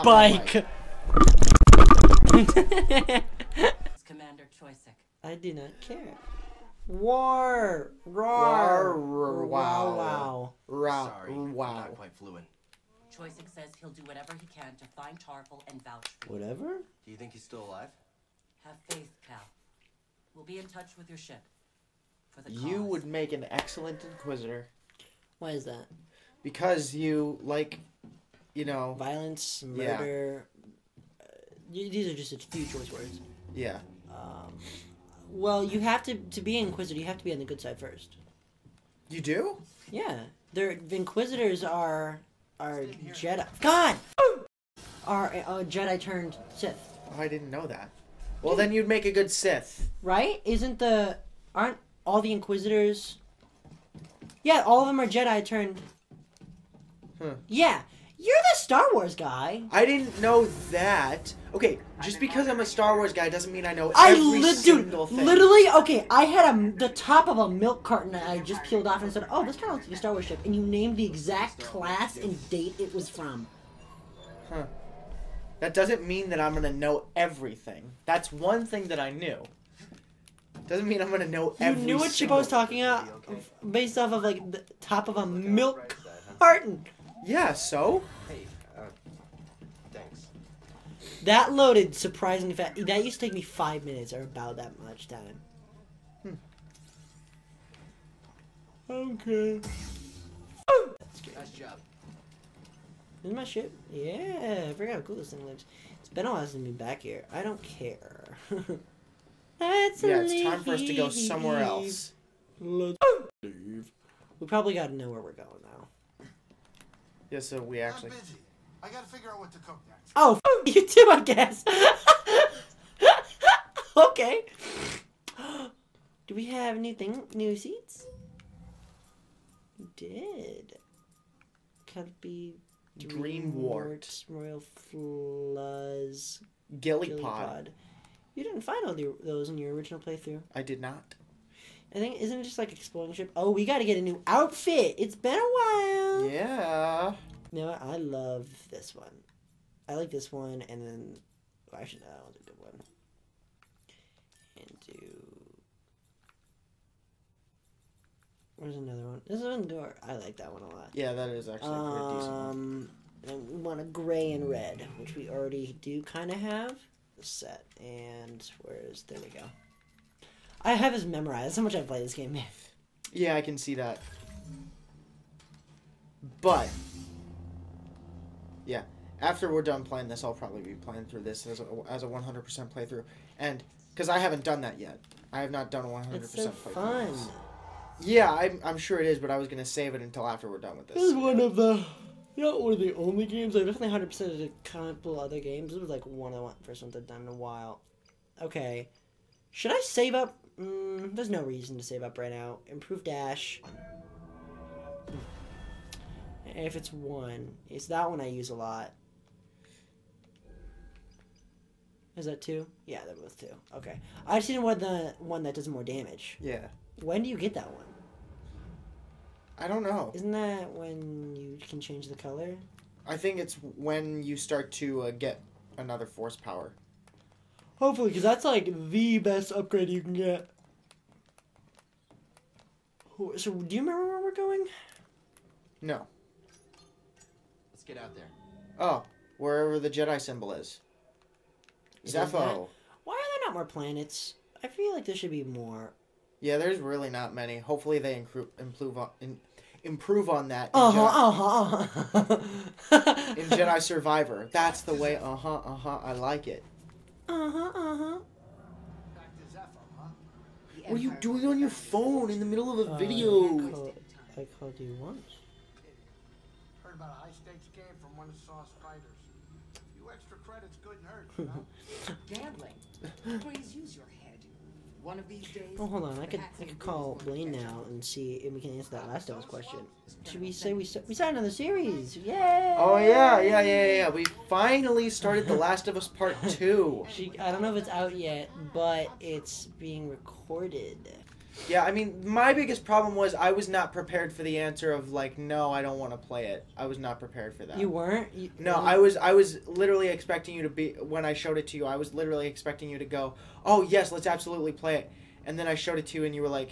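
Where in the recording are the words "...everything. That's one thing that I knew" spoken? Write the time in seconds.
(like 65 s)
77 s.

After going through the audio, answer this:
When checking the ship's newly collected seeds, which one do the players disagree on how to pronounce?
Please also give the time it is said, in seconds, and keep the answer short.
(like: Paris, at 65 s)
Gillipod, at 137 s.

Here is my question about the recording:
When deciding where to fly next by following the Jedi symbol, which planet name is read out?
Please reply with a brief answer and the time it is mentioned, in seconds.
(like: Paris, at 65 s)
Zeffo, at 242 s.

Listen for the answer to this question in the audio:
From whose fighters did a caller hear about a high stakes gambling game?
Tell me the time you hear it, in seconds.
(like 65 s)
268 s.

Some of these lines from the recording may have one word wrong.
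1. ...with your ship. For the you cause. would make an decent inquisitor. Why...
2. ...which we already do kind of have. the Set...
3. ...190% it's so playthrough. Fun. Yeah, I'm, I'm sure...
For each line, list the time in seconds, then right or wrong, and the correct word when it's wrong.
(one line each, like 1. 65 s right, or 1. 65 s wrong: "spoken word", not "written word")
1. 20 s wrong: "excellent", not "decent"
2. 164 s right
3. 185 s wrong: "100", not "190".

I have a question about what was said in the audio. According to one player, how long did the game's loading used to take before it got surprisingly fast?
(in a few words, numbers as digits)
5 minutes.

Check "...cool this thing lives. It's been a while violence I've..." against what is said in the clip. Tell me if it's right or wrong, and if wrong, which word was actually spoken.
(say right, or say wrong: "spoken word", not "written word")
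wrong: "since", not "violence".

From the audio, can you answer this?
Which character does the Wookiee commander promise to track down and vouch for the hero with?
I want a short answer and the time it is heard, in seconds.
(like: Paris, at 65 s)
Tarfful, at 15 s.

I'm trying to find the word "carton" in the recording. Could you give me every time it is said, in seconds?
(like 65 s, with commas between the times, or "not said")
67 s, 86 s.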